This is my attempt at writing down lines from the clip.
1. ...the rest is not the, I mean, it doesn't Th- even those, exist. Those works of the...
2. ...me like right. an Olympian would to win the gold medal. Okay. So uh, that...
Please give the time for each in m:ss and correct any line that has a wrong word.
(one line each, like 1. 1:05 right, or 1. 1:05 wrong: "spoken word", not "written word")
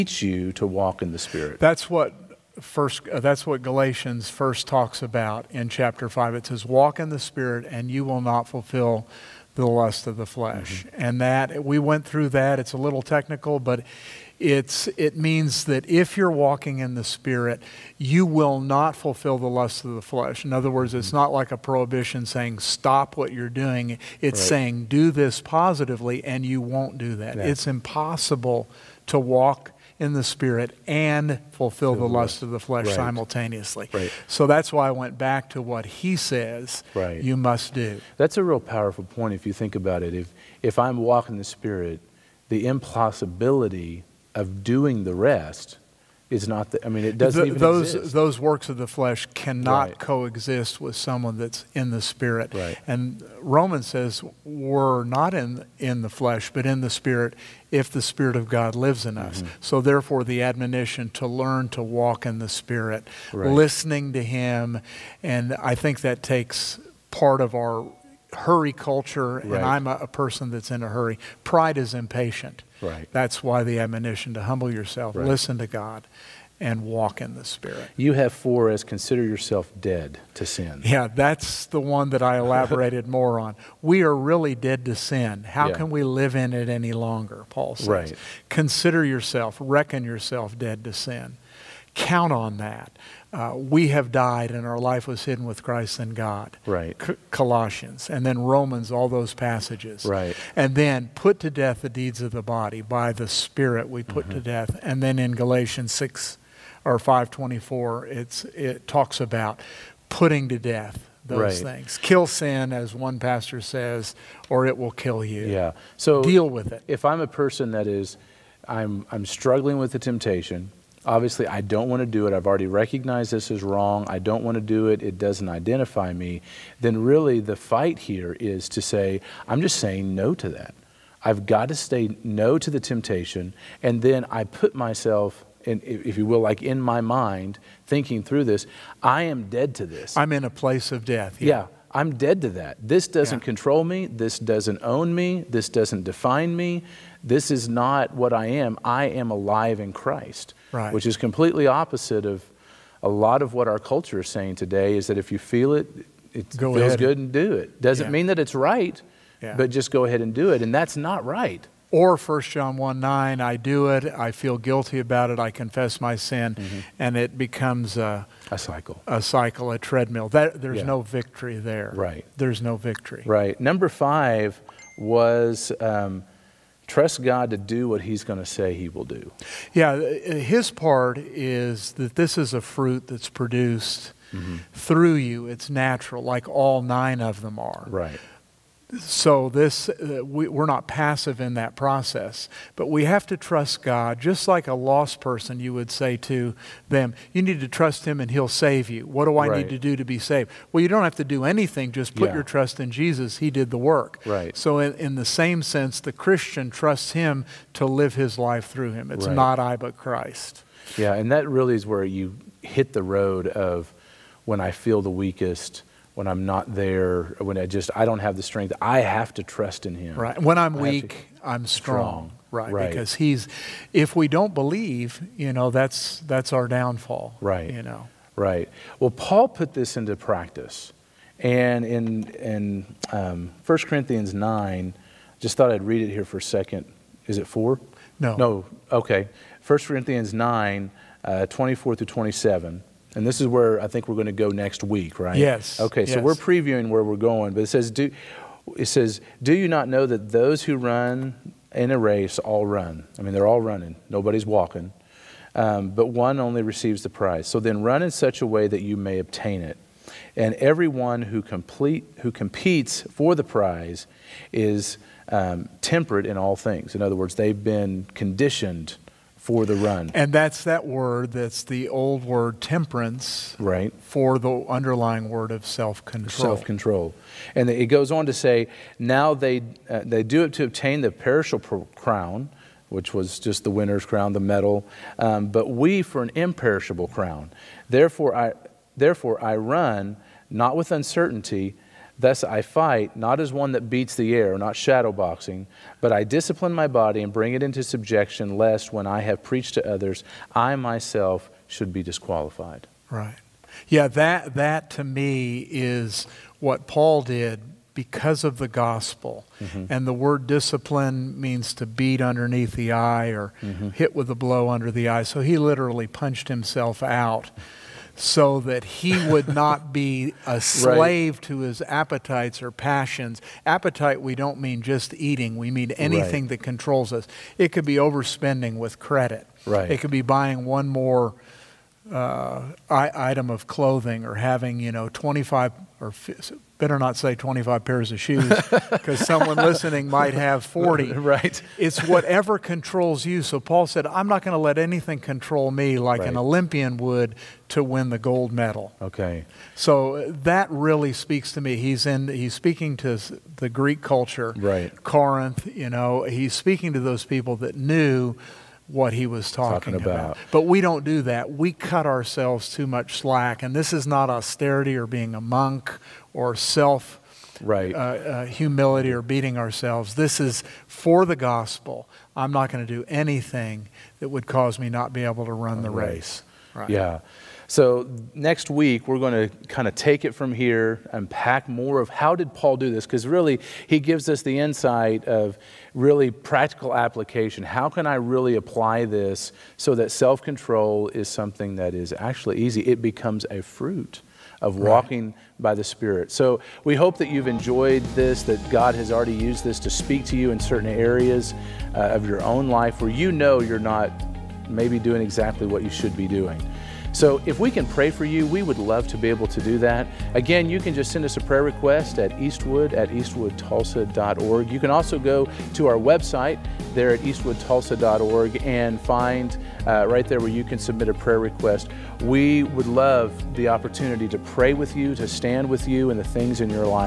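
1. 0:45 right
2. 5:45 right.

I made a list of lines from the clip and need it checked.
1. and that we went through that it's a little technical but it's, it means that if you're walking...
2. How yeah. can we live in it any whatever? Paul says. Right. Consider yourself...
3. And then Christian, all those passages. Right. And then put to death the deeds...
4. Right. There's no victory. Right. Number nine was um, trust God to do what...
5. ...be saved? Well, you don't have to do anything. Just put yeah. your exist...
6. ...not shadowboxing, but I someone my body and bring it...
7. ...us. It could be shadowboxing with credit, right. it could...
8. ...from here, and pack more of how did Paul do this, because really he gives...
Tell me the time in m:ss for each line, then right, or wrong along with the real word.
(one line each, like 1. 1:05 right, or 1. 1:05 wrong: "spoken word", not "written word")
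1. 0:11 right
2. 1:25 wrong: "longer", not "whatever"
3. 1:38 wrong: "Romans", not "Christian"
4. 2:51 wrong: "five", not "nine"
5. 3:20 wrong: "trust", not "exist"
6. 4:54 wrong: "discipline", not "someone"
7. 5:27 wrong: "overspending", not "shadowboxing"
8. 6:20 right.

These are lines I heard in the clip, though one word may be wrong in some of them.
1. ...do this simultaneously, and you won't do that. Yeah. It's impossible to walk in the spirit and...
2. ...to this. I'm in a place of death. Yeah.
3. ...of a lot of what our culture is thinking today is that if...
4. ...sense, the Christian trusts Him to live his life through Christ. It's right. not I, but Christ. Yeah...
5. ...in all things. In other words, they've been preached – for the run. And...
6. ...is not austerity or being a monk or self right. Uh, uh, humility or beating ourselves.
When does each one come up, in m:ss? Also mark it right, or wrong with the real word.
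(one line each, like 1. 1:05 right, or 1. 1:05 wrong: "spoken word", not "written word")
1. 0:24 wrong: "positively", not "simultaneously"
2. 2:19 right
3. 2:32 wrong: "saying", not "thinking"
4. 3:25 wrong: "Him", not "Christ"
5. 4:26 wrong: "conditioned", not "preached"
6. 6:03 right.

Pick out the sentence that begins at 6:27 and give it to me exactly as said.
How can I really apply this so that self control is something that is actually easy?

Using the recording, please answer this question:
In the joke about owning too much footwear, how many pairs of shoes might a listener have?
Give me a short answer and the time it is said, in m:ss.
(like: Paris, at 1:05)
40, at 5:40.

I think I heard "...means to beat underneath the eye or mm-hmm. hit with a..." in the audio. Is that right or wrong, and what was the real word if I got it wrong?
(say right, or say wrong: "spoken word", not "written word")
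right.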